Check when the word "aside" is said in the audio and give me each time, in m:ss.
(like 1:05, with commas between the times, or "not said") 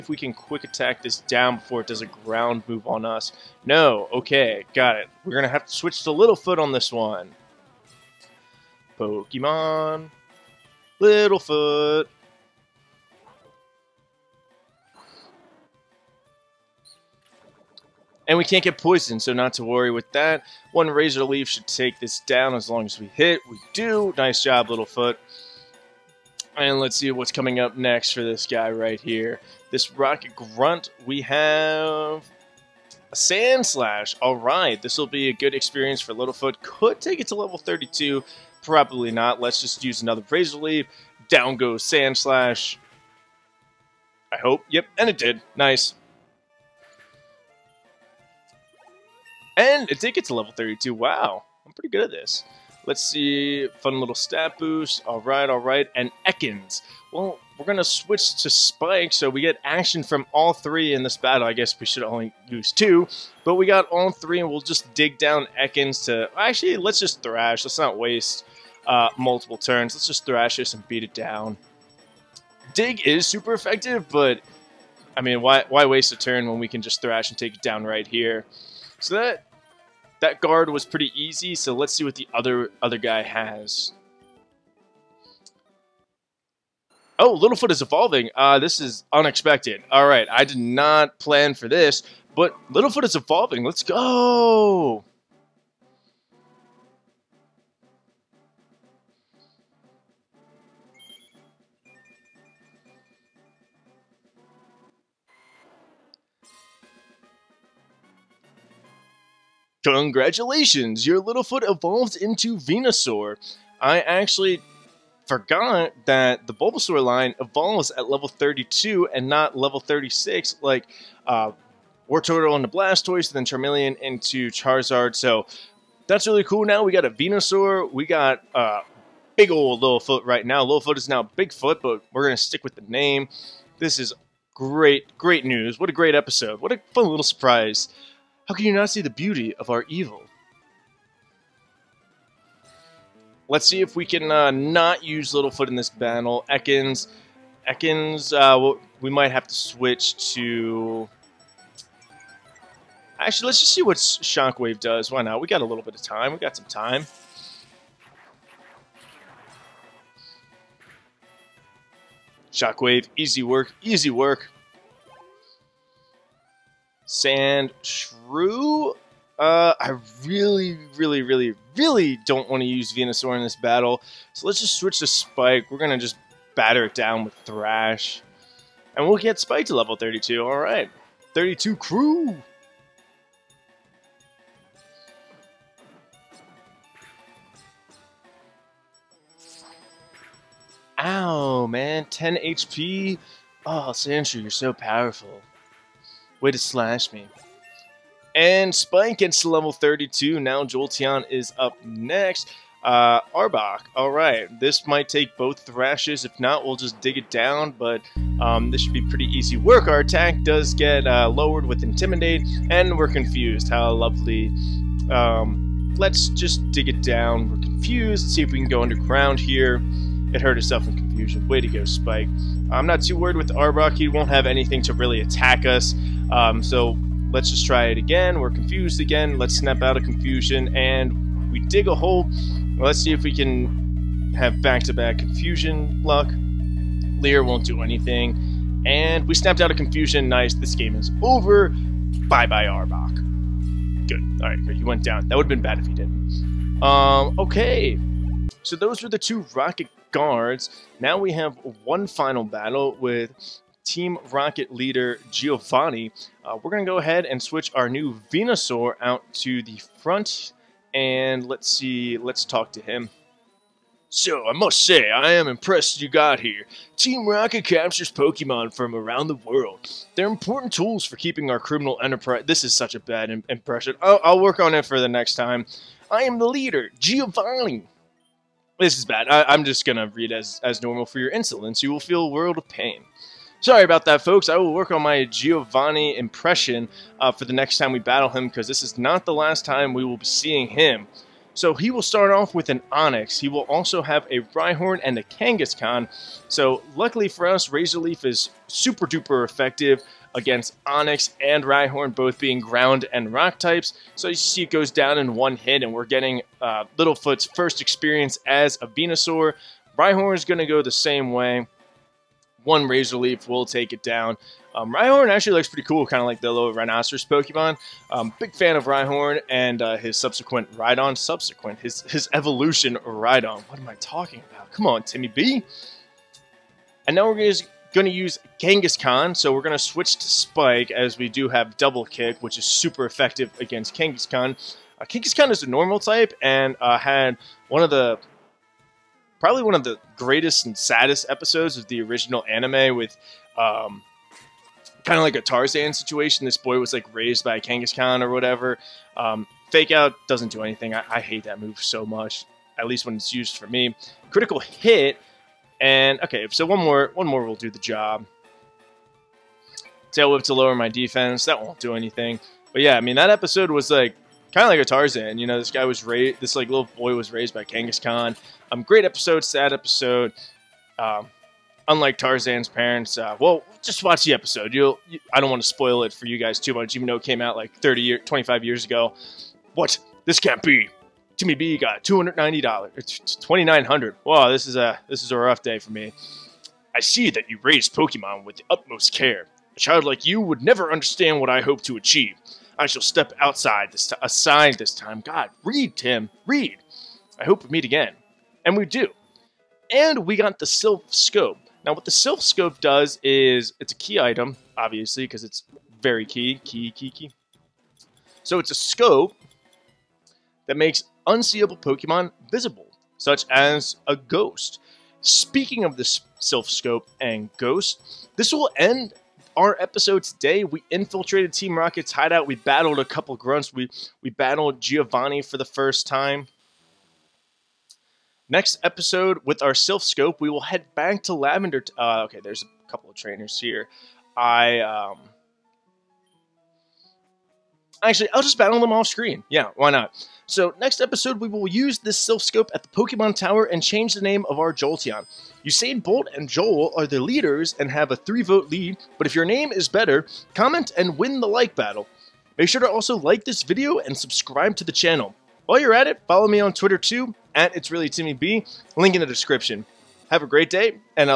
6:34.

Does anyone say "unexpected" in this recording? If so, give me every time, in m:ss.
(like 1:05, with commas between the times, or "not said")
1:29.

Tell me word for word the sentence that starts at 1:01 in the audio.
I guess we should only use two, but we got all three, and we'll just dig down Ekans to...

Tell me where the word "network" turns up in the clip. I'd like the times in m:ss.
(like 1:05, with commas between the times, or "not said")
not said.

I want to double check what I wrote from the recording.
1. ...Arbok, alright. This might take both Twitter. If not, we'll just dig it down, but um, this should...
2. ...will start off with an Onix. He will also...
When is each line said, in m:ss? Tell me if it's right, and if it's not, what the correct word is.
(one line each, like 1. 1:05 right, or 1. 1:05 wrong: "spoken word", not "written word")
1. 3:23 wrong: "Thrashes", not "Twitter"
2. 4:51 right.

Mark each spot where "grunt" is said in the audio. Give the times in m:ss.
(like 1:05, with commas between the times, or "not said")
0:30, 7:03.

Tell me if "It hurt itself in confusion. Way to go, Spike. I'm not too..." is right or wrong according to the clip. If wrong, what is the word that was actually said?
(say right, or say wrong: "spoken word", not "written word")
right.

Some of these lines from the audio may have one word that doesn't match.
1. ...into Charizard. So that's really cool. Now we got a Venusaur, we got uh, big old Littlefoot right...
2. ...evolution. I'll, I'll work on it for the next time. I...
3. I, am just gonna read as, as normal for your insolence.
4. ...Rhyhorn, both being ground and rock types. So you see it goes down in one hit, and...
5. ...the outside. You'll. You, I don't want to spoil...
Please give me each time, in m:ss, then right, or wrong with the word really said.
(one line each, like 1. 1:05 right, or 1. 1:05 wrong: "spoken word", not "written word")
1. 2:04 right
2. 4:33 wrong: "impression", not "evolution"
3. 4:39 right
4. 5:01 right
5. 6:14 wrong: "episode", not "outside".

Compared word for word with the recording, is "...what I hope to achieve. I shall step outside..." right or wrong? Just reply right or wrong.
right.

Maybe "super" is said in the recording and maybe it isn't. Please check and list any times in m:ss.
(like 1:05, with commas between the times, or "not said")
1:13, 4:58, 5:32.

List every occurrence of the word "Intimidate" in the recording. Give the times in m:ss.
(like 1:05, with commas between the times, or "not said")
3:31.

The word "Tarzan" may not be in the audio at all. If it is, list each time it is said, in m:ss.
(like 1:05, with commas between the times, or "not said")
5:45, 6:04, 6:12.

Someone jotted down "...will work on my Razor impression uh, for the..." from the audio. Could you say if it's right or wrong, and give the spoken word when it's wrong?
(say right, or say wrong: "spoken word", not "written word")
wrong: "Giovanni", not "Razor".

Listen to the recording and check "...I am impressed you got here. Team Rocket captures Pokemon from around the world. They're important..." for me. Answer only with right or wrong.
right.